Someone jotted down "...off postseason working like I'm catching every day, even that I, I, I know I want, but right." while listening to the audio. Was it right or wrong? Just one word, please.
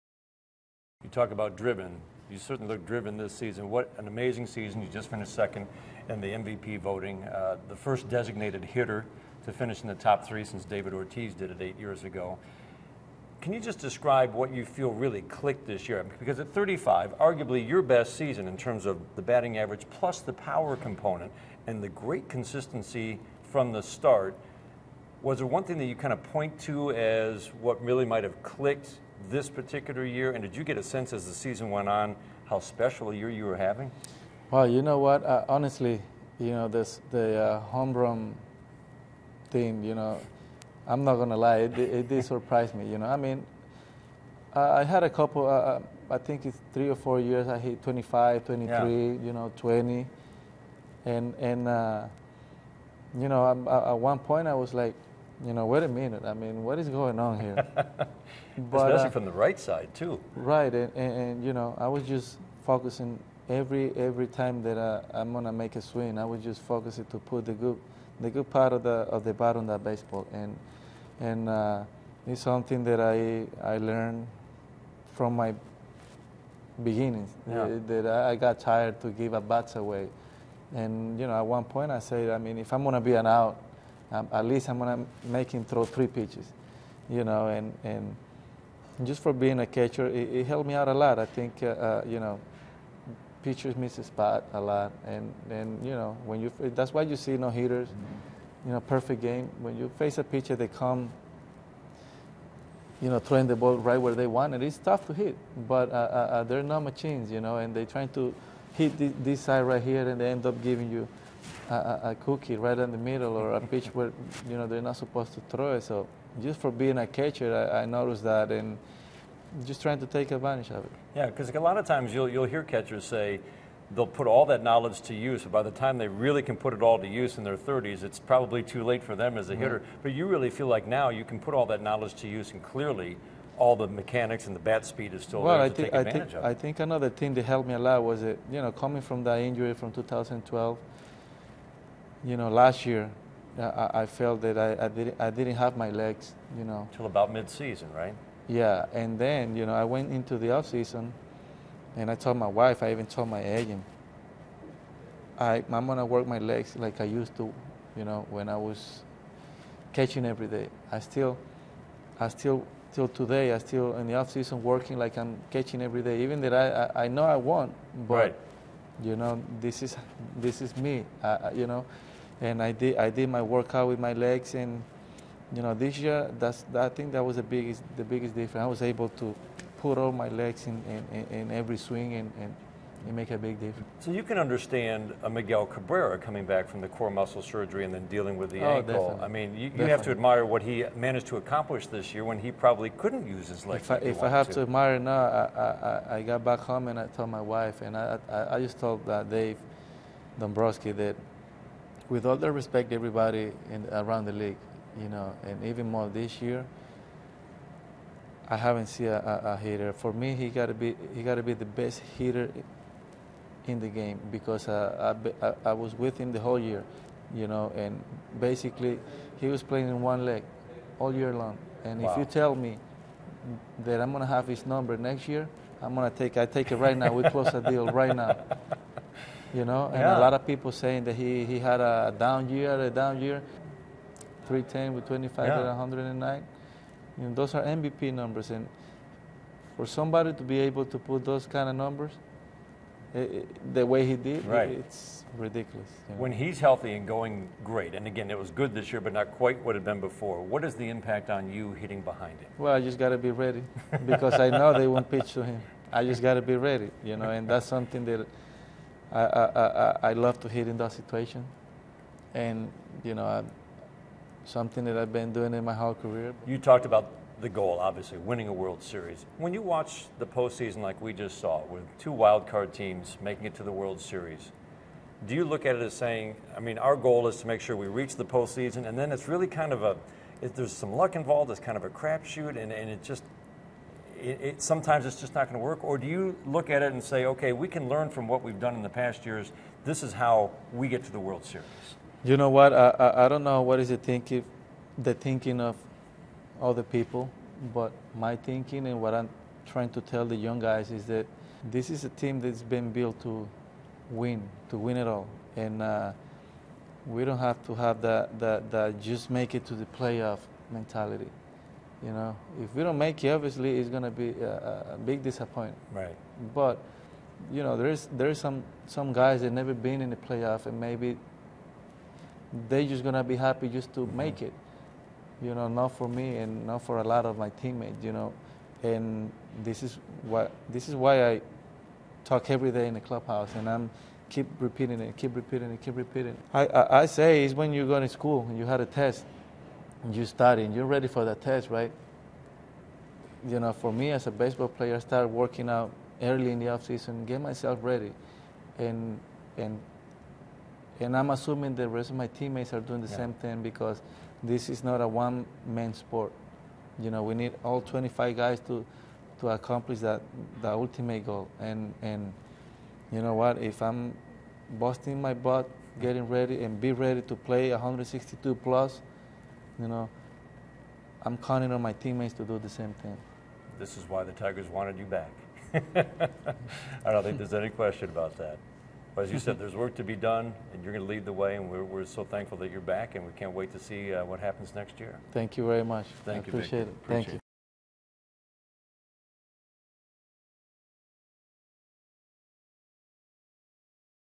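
wrong.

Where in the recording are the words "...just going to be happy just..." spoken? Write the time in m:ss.
5:22.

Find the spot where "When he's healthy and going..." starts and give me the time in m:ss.
4:06.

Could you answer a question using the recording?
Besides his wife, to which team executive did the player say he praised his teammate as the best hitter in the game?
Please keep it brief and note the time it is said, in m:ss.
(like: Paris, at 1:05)
Dave Dombrowski, at 3:19.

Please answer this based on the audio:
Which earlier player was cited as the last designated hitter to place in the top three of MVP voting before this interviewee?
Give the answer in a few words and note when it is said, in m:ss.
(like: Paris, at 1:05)
David Ortiz, at 0:10.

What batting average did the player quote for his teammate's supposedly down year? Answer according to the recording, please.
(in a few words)
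310.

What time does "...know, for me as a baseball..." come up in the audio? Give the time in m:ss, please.
5:43.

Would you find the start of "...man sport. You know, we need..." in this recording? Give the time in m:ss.
5:55.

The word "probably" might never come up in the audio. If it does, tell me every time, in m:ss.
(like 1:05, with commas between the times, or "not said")
2:08, 3:12.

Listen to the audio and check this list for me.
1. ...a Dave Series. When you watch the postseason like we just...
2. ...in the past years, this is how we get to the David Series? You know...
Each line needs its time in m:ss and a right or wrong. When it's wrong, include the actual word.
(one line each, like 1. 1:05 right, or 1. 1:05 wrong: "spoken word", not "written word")
1. 4:28 wrong: "World", not "Dave"
2. 4:48 wrong: "World", not "David".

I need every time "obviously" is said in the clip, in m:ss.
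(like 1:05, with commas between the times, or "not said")
4:27, 5:13.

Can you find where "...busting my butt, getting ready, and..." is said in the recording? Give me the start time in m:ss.
6:04.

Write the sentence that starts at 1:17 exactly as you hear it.
Uh, that, I got tired to give a bats away.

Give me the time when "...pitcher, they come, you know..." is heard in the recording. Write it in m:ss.
1:40.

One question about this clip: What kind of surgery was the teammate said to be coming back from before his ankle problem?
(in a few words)
core muscle surgery.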